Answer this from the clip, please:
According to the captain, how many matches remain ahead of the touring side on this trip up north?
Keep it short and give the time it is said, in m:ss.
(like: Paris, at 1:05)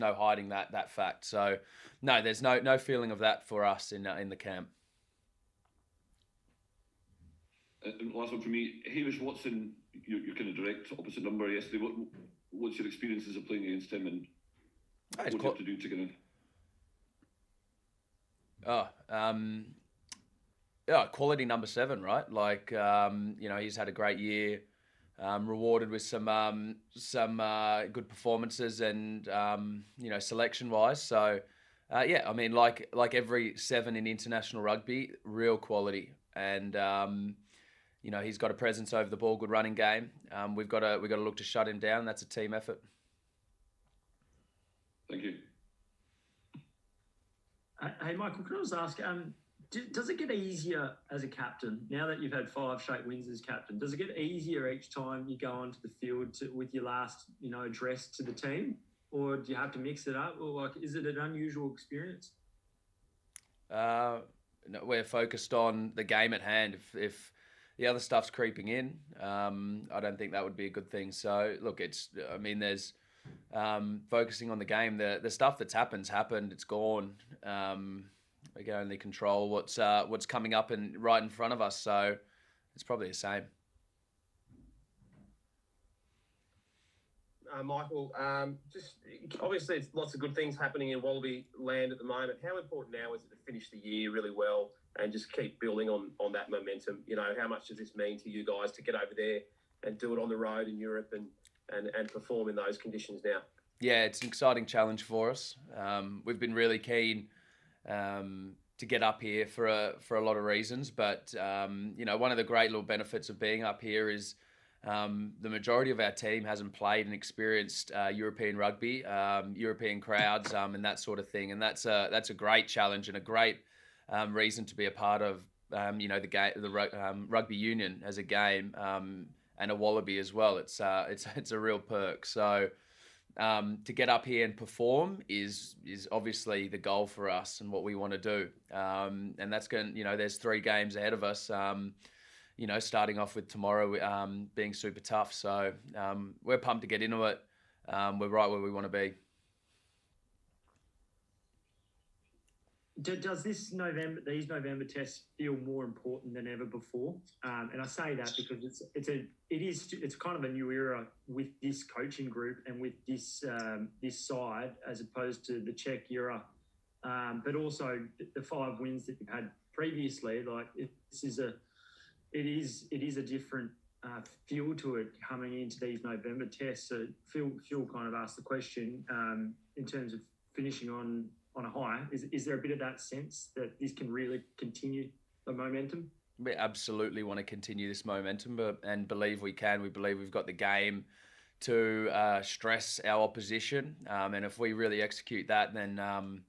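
3, at 2:20.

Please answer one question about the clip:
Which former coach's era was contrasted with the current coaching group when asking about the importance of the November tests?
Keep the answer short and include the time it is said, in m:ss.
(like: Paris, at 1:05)
Cheika, at 2:45.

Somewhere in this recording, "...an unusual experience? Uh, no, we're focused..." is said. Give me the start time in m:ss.
1:01.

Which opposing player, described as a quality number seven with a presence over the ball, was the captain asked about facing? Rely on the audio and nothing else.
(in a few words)
Hamish Watson.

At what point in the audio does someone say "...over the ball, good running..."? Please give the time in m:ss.
0:38.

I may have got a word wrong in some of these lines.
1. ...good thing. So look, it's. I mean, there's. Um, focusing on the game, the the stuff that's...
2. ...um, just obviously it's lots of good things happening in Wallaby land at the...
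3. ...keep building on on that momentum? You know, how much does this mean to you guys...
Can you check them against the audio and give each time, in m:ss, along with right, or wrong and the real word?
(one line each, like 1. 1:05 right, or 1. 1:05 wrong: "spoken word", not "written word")
1. 1:10 right
2. 1:28 right
3. 1:35 right.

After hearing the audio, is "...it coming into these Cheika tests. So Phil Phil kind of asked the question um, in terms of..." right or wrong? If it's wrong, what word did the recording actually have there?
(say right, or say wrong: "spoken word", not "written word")
wrong: "November", not "Cheika".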